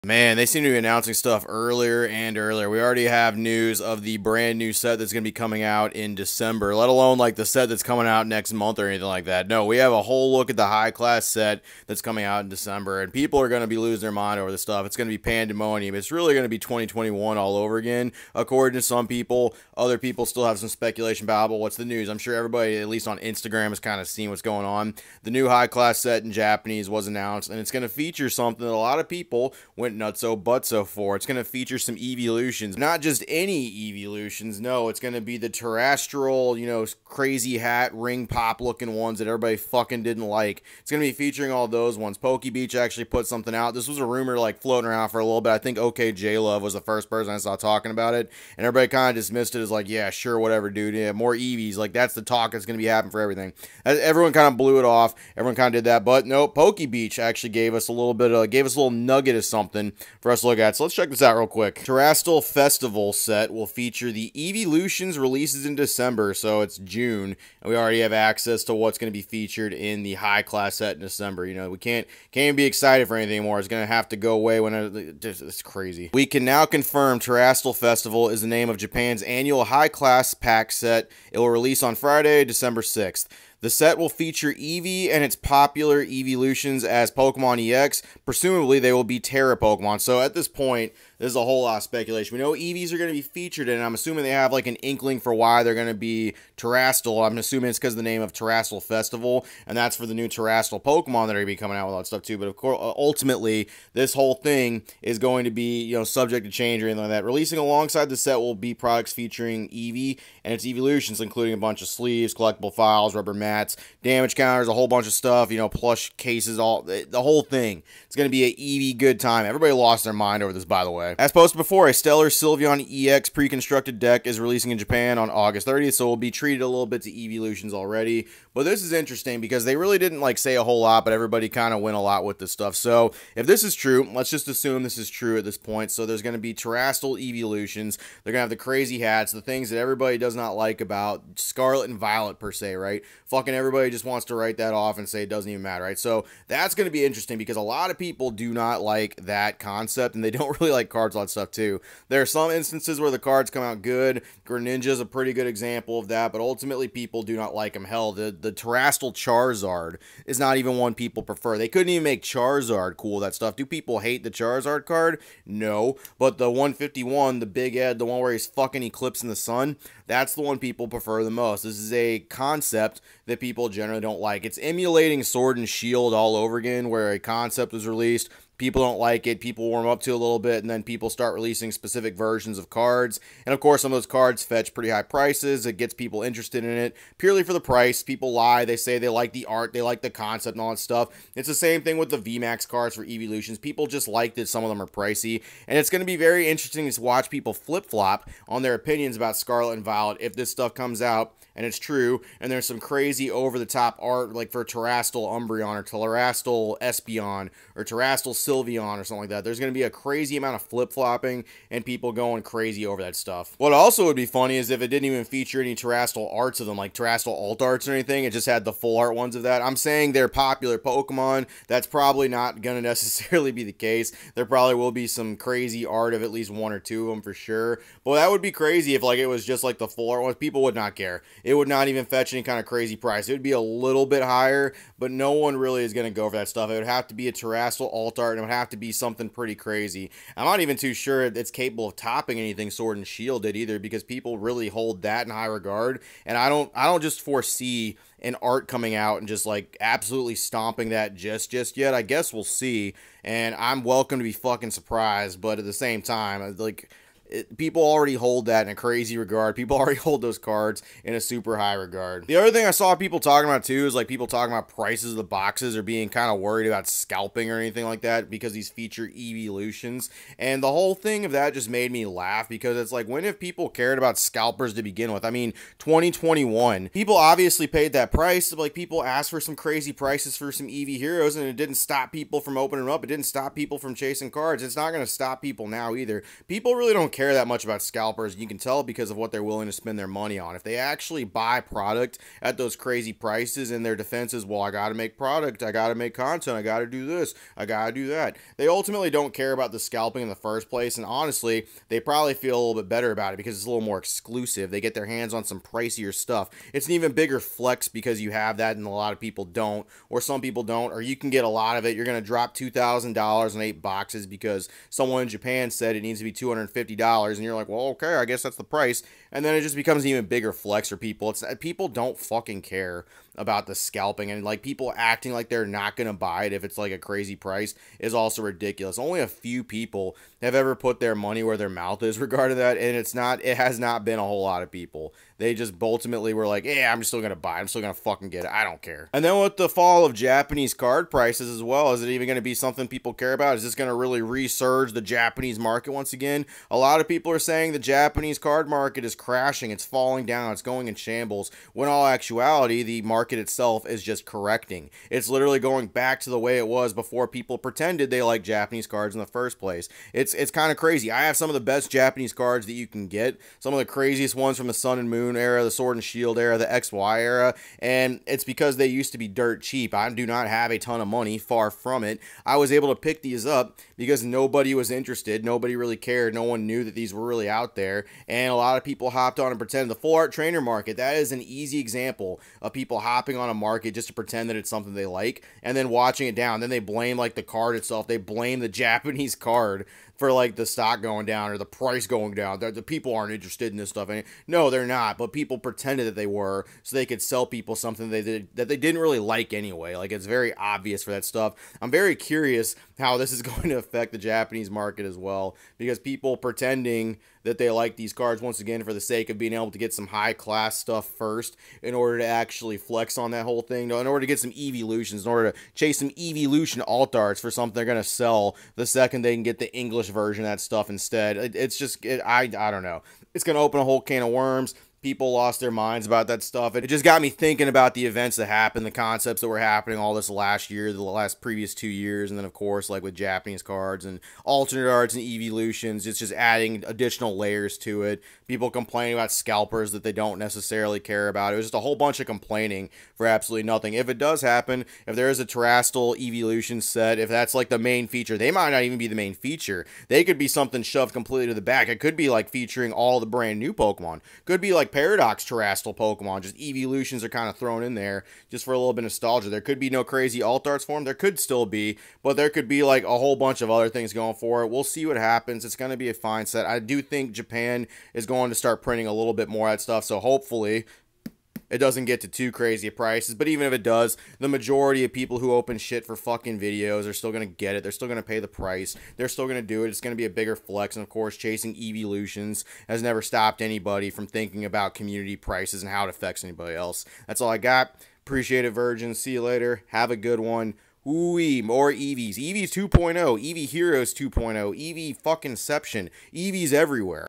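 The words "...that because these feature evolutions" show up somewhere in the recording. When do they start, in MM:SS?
04:28.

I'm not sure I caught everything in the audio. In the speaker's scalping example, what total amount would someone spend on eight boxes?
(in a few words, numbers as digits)
$2,000.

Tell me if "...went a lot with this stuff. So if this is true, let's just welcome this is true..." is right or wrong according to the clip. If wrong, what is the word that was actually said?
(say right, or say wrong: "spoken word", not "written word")
wrong: "assume", not "welcome".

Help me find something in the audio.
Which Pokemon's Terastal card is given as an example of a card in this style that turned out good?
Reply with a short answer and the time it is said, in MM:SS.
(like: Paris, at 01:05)
Greninja, at 02:34.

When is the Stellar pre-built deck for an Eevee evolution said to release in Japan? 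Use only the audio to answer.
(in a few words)
August 30th.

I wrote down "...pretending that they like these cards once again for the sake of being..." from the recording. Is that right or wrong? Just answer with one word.
right.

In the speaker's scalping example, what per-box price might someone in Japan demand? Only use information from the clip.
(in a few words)
$250.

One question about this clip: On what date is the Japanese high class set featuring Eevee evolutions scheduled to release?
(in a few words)
Friday, December 6th.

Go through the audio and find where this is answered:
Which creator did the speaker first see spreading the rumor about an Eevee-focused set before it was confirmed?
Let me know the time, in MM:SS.
00:45.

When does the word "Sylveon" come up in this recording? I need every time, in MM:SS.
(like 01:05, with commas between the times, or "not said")
02:02, 03:28.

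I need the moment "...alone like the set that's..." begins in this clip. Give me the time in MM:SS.
00:06.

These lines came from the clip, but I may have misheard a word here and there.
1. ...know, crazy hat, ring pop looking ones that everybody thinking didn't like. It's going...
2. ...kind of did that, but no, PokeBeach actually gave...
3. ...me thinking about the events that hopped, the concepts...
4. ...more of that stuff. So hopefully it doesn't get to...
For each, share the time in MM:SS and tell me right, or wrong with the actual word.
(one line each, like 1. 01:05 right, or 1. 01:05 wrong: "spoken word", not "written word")
1. 00:36 wrong: "fucking", not "thinking"
2. 00:55 right
3. 07:07 wrong: "happened", not "hopped"
4. 07:49 right.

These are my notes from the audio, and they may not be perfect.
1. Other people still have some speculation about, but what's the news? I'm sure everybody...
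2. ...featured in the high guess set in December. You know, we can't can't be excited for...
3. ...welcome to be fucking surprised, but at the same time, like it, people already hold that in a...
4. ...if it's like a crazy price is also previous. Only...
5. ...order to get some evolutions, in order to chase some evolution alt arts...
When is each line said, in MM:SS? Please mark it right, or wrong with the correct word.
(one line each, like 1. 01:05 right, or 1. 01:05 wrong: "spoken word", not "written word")
1. 00:19 right
2. 01:09 wrong: "class", not "guess"
3. 04:13 right
4. 05:26 wrong: "ridiculous", not "previous"
5. 06:54 right.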